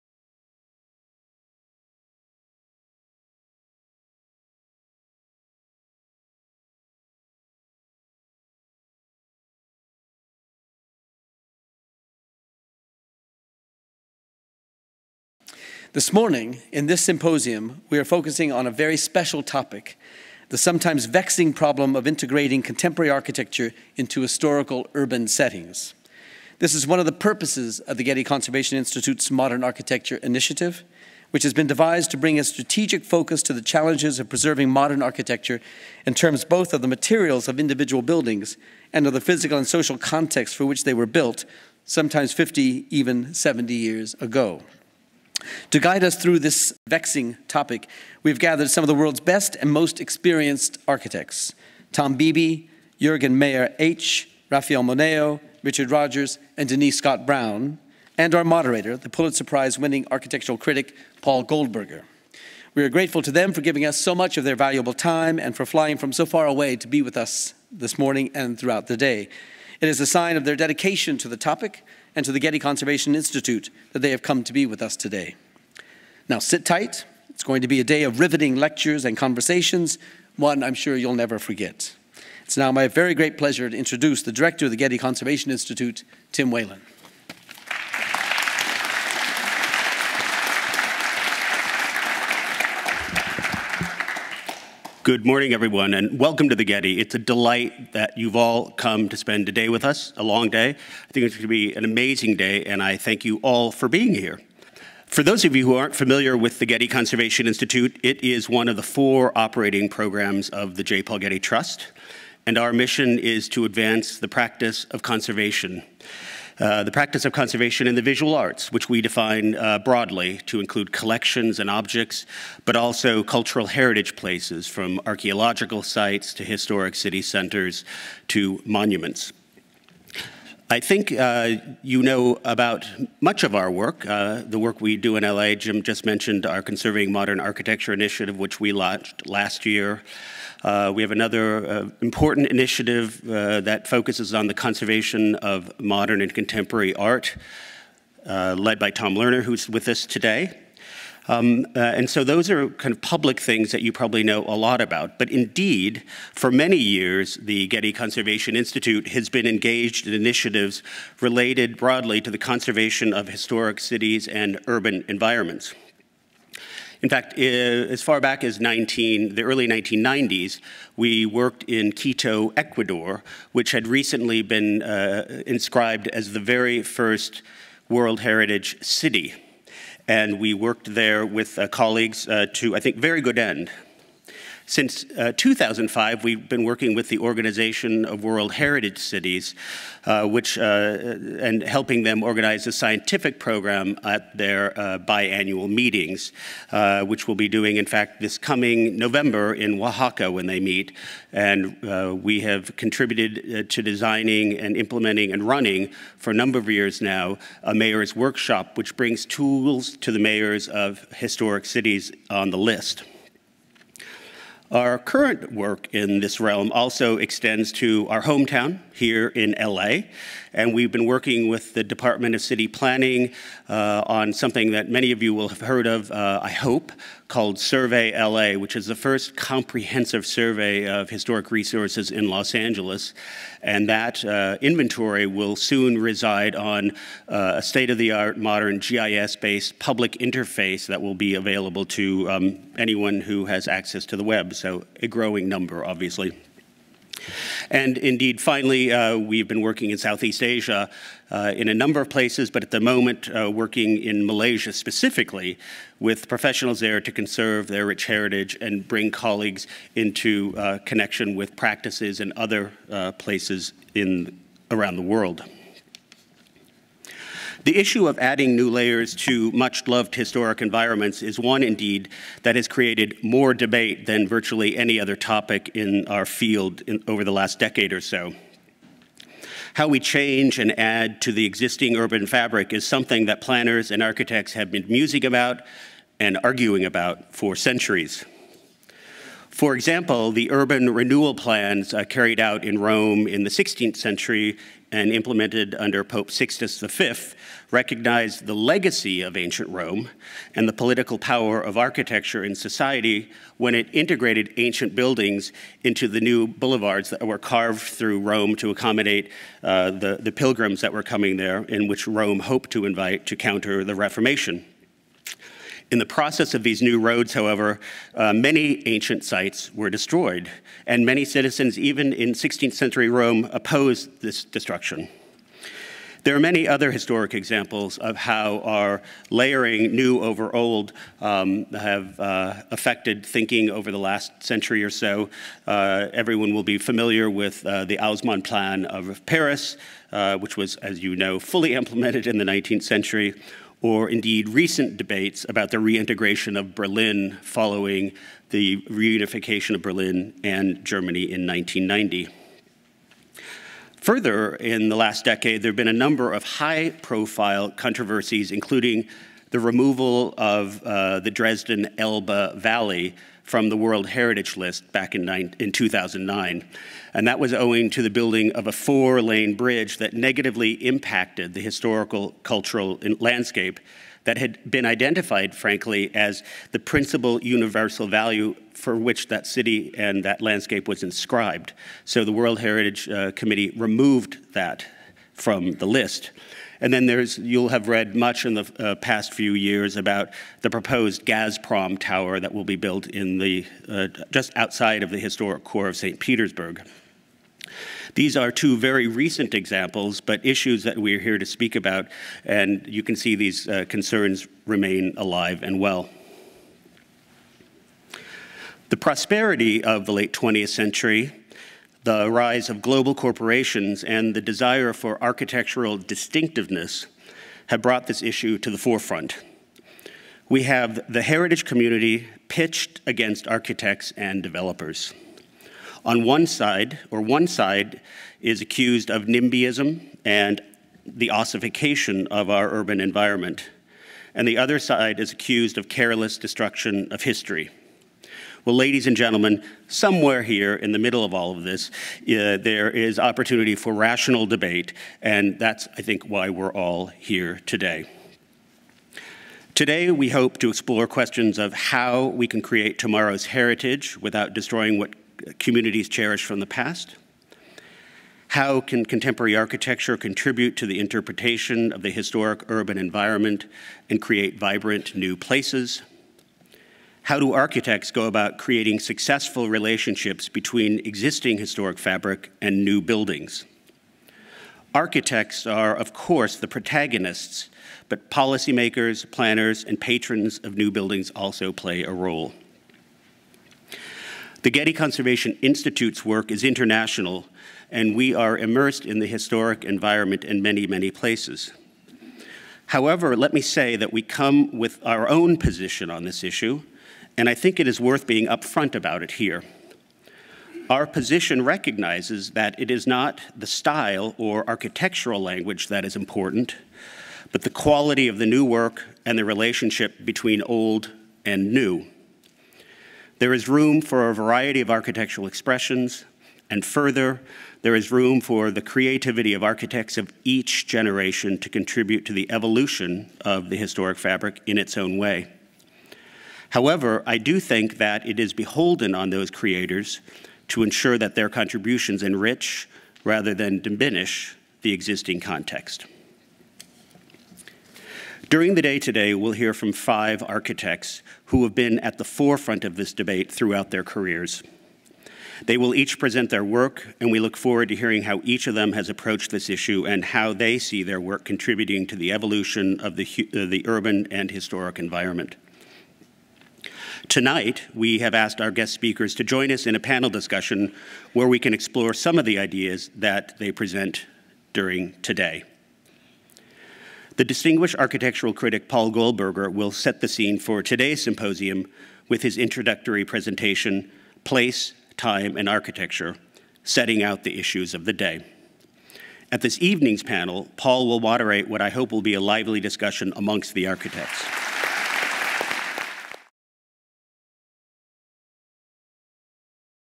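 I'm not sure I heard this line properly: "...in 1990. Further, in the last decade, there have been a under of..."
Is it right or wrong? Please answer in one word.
wrong.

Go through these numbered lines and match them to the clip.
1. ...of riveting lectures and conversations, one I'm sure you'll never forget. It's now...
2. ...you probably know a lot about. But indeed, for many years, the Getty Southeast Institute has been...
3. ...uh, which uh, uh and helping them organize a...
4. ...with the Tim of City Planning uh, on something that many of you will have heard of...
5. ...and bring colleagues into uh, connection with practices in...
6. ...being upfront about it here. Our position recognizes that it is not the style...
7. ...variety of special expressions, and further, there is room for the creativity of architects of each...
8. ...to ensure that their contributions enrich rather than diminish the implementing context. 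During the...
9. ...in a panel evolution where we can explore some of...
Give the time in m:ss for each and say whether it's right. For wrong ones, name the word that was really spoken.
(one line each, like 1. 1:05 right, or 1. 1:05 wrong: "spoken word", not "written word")
1. 1:18 right
2. 2:33 wrong: "Conservation", not "Southeast"
3. 3:10 right
4. 3:41 wrong: "Department", not "Tim"
5. 4:18 right
6. 8:18 right
7. 8:34 wrong: "architectural", not "special"
8. 8:50 wrong: "existing", not "implementing"
9. 9:19 wrong: "discussion", not "evolution".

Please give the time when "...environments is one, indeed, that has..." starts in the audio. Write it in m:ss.
4:30.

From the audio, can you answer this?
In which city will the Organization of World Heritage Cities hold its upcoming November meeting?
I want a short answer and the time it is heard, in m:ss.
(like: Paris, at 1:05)
Oaxaca, at 3:19.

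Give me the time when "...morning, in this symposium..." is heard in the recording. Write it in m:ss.
0:16.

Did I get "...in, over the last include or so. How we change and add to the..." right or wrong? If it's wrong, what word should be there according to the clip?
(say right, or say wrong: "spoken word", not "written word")
wrong: "decade", not "include".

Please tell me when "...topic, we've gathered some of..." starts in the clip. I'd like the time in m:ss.
0:47.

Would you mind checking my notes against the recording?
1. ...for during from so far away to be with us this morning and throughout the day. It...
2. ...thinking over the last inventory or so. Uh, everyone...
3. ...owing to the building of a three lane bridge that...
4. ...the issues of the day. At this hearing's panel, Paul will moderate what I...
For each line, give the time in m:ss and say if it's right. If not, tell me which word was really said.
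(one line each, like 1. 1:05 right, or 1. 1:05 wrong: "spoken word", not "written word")
1. 1:05 wrong: "flying", not "during"
2. 5:33 wrong: "century", not "inventory"
3. 6:07 wrong: "four", not "three"
4. 9:37 wrong: "evening", not "hearing".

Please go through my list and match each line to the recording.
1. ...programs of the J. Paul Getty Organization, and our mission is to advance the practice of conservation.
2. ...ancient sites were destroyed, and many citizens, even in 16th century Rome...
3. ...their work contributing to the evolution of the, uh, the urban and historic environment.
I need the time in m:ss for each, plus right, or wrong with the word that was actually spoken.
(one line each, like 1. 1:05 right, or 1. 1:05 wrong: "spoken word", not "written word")
1. 1:49 wrong: "Trust", not "Organization"
2. 5:18 right
3. 9:11 right.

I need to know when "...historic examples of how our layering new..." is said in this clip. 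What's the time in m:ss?
5:26.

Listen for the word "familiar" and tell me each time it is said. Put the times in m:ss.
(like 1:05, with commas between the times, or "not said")
1:45, 5:36.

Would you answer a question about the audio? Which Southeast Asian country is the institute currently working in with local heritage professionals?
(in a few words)
Malaysia.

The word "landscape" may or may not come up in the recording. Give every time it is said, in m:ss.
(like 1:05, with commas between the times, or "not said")
6:13, 6:20.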